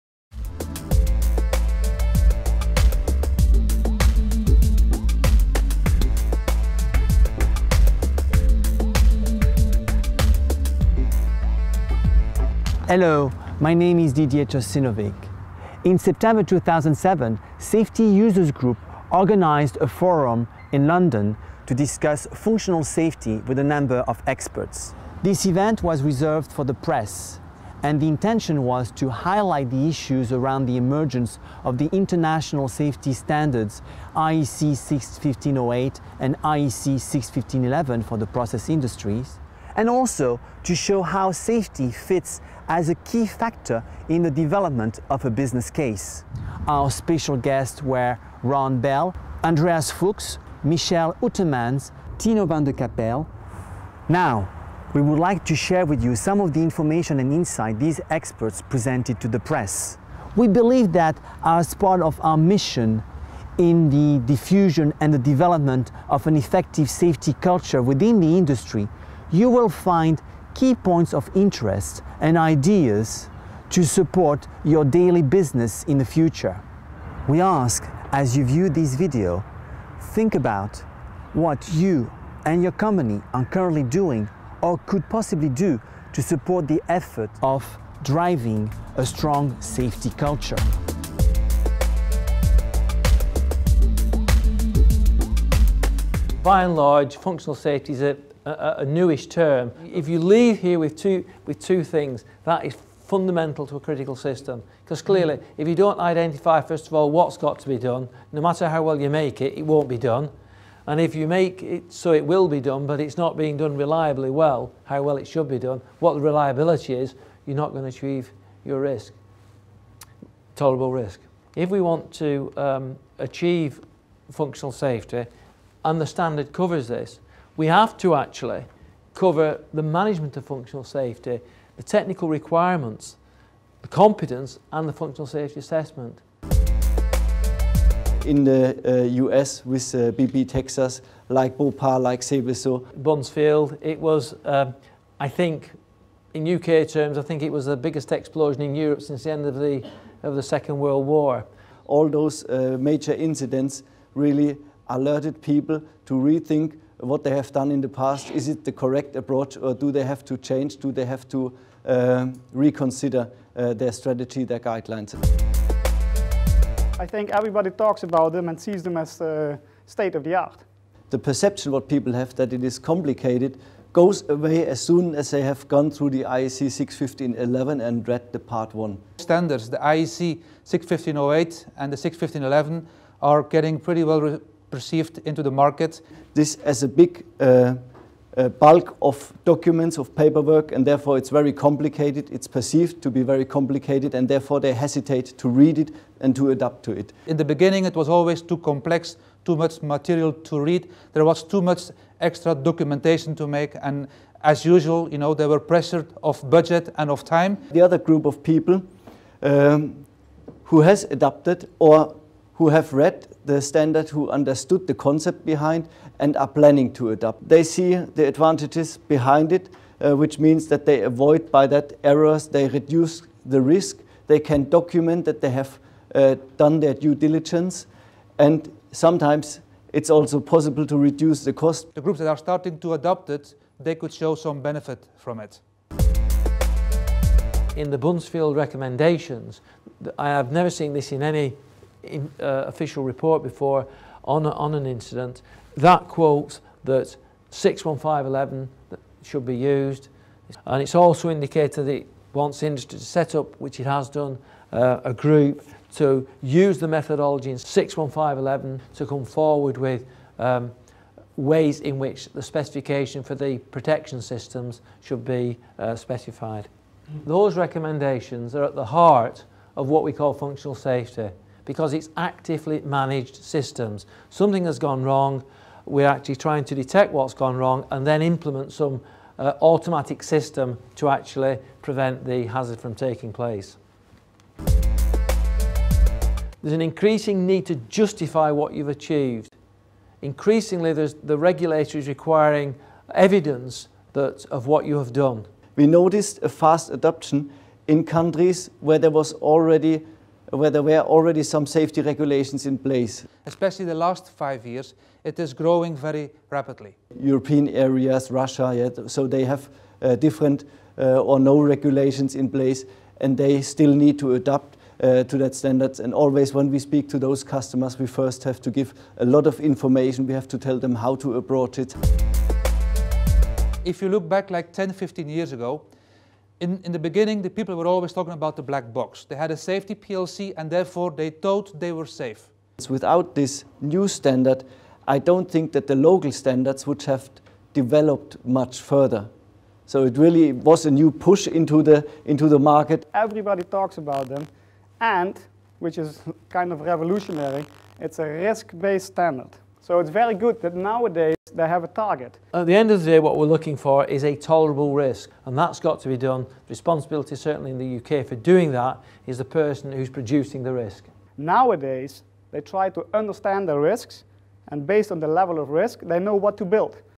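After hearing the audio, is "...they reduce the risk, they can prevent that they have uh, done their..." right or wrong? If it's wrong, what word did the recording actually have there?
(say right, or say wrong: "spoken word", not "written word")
wrong: "document", not "prevent".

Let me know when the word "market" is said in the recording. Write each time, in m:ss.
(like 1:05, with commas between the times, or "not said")
3:05, 5:42.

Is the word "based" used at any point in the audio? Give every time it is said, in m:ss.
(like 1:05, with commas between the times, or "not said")
5:48, 6:04.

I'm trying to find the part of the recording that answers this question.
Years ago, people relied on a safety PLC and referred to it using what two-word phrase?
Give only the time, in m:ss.
5:28.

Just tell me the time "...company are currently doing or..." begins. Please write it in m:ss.
1:22.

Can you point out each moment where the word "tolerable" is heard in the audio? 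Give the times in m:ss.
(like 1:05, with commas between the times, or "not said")
2:00, 5:54.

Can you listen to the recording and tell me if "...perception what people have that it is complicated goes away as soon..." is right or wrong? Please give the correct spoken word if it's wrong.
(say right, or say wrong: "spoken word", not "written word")
right.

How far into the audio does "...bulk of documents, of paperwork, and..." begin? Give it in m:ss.
3:08.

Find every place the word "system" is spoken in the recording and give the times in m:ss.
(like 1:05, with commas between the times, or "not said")
1:44, 4:24, 4:33, 4:40.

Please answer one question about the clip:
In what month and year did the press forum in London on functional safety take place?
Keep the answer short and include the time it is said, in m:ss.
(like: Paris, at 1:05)
September 2007, at 0:15.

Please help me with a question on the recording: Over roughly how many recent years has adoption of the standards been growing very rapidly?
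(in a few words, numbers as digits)
5 years.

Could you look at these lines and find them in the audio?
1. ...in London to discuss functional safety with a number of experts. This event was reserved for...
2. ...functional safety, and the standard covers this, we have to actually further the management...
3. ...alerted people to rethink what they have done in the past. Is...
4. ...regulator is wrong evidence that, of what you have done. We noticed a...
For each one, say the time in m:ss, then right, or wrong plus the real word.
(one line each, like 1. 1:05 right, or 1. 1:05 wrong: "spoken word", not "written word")
1. 0:20 right
2. 2:04 wrong: "cover", not "further"
3. 2:34 right
4. 4:51 wrong: "requiring", not "wrong".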